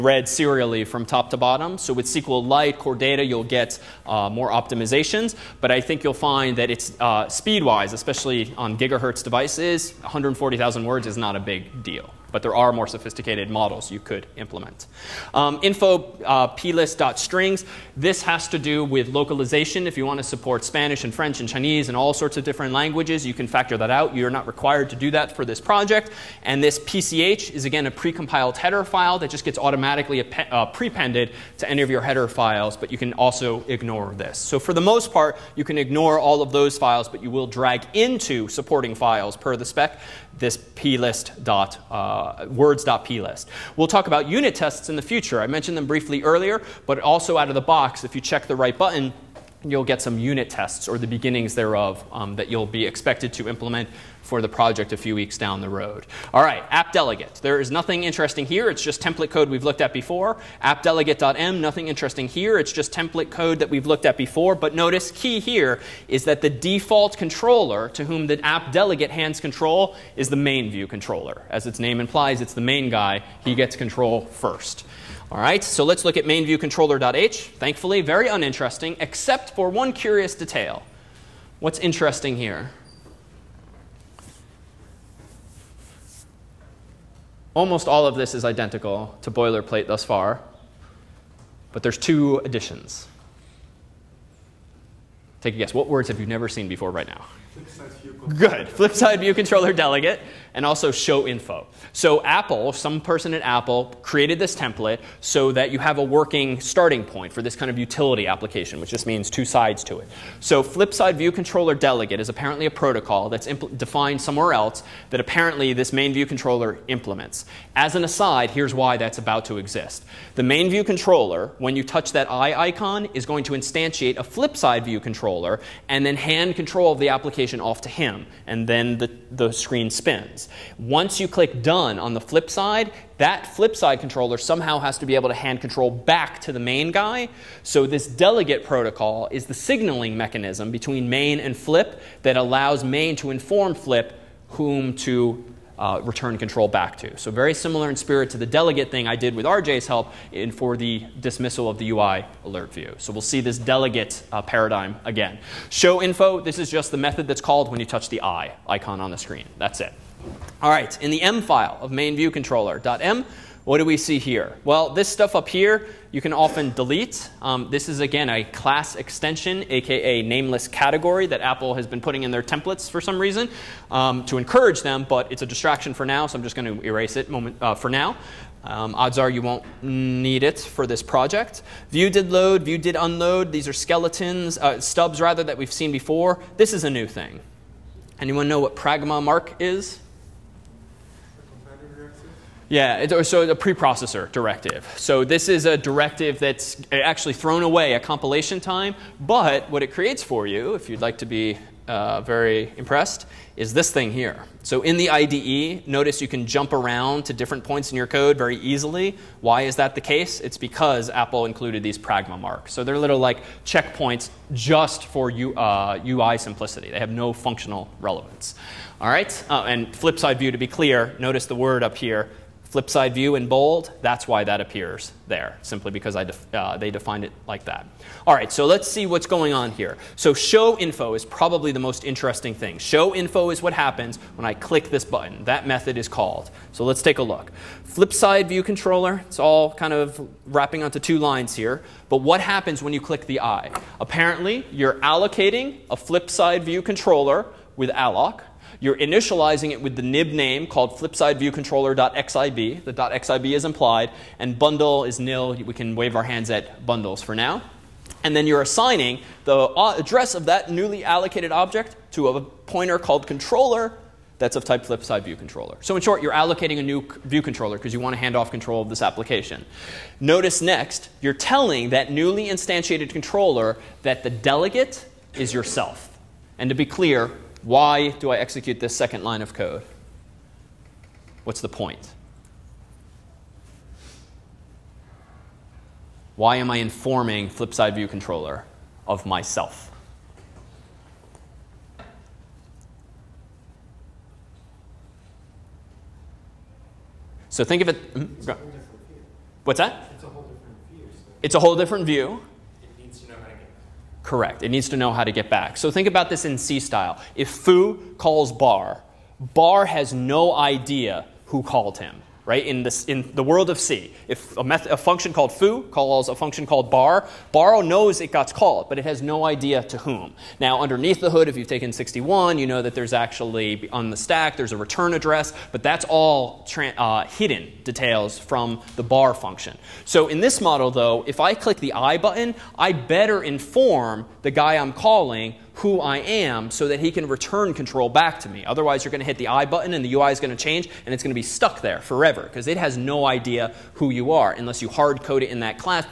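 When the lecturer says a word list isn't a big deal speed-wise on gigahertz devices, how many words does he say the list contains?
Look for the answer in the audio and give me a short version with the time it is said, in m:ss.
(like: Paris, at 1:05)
140,000, at 0:10.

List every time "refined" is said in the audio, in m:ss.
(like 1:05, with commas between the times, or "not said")
not said.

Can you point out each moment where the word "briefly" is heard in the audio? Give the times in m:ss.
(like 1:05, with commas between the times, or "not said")
0:45.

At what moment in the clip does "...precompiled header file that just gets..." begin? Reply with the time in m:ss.
0:27.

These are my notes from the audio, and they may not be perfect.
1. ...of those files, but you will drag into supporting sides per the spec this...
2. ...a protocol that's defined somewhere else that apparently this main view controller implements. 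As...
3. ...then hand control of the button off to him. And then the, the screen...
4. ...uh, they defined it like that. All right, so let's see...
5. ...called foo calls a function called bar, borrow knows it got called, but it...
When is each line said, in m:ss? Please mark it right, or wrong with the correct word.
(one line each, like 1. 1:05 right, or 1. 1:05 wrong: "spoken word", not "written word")
1. 0:36 wrong: "files", not "sides"
2. 1:52 right
3. 2:06 wrong: "application", not "button"
4. 3:46 right
5. 5:15 right.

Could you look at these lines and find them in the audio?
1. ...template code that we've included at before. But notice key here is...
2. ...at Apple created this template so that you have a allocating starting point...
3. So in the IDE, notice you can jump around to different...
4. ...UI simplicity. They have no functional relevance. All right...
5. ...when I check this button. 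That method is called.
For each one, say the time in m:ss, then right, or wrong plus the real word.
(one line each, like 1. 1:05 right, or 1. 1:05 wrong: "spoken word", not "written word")
1. 1:02 wrong: "looked", not "included"
2. 1:43 wrong: "working", not "allocating"
3. 3:24 right
4. 3:36 right
5. 3:54 wrong: "click", not "check".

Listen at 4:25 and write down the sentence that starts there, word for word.
So in short, you're allocating a new view controller because you want to hand off control of this application.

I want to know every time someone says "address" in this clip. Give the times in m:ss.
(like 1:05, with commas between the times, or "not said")
4:19, 5:25.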